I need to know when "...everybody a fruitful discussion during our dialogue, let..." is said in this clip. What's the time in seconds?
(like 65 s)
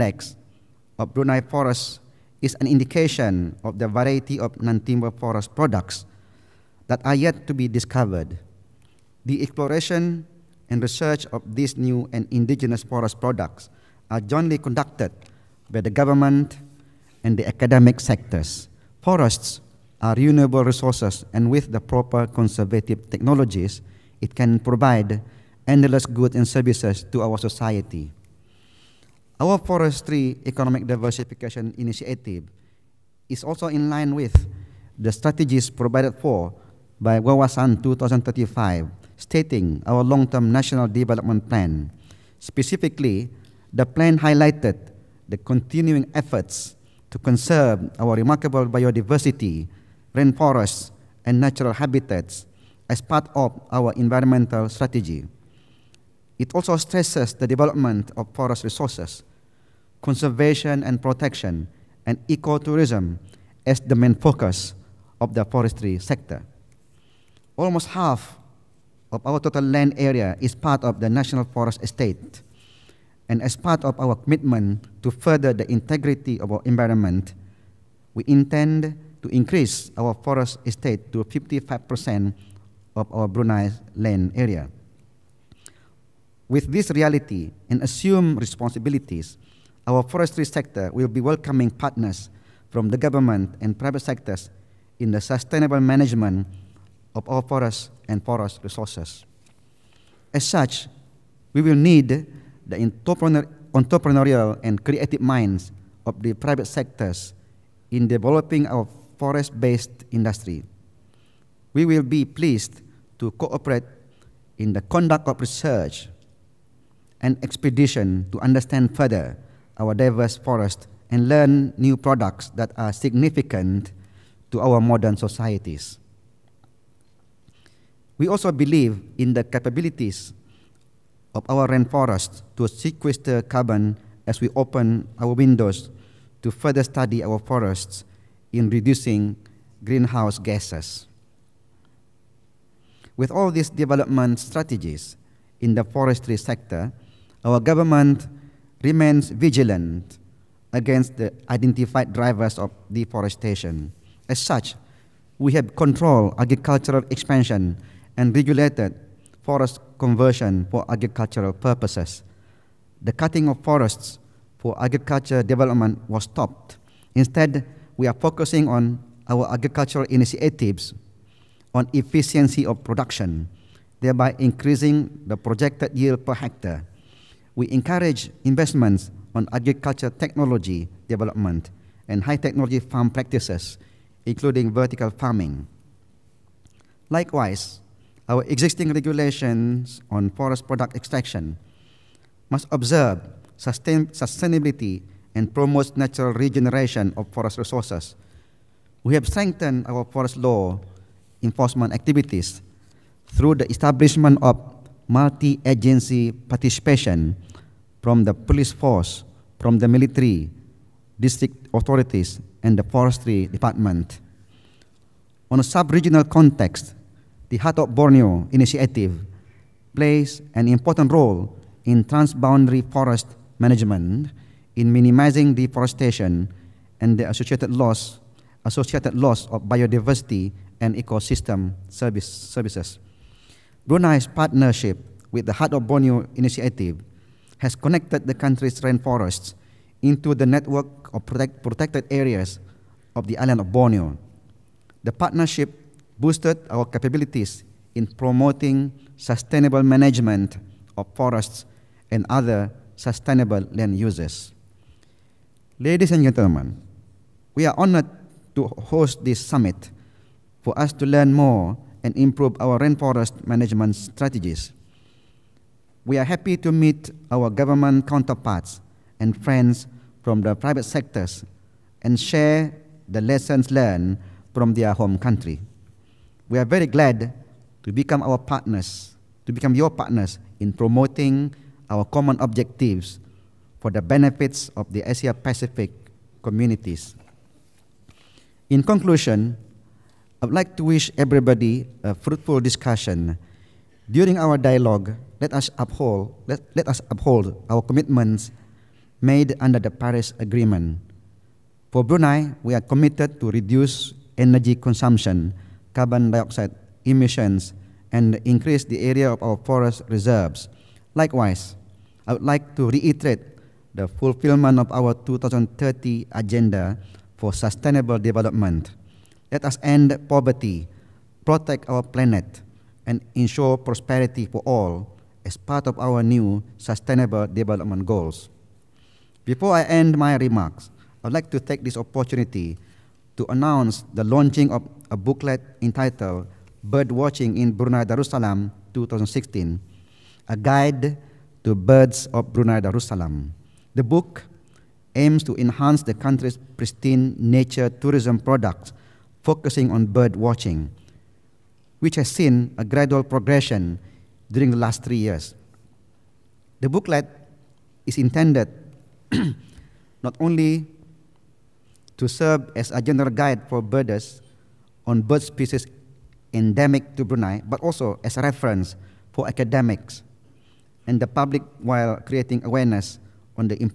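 291 s.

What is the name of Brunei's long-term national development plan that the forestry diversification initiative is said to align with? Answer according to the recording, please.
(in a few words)
Wawasan 2035.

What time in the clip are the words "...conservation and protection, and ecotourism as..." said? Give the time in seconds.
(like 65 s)
60 s.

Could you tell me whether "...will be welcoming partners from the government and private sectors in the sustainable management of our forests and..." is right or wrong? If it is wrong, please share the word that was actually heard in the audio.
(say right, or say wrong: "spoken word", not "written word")
right.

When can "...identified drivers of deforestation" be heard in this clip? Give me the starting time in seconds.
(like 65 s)
151 s.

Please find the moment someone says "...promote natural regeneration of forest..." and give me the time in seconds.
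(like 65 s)
195 s.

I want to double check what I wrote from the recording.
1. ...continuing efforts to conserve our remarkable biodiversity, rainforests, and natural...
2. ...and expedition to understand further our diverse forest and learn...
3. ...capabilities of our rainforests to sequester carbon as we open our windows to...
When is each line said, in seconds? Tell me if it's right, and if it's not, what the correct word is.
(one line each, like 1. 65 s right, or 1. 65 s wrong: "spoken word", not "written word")
1. 45 s right
2. 117 s right
3. 129 s right.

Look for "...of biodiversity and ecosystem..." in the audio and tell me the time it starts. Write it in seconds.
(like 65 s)
229 s.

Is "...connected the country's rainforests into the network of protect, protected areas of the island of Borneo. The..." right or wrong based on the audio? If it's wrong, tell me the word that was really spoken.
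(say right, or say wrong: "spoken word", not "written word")
right.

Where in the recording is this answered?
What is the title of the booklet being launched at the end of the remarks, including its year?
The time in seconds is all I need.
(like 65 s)
336 s.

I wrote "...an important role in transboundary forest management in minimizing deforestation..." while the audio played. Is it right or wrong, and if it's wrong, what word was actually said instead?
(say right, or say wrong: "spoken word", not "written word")
right.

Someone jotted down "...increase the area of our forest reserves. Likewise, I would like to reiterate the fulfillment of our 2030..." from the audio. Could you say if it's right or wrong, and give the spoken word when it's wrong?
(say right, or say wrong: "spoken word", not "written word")
right.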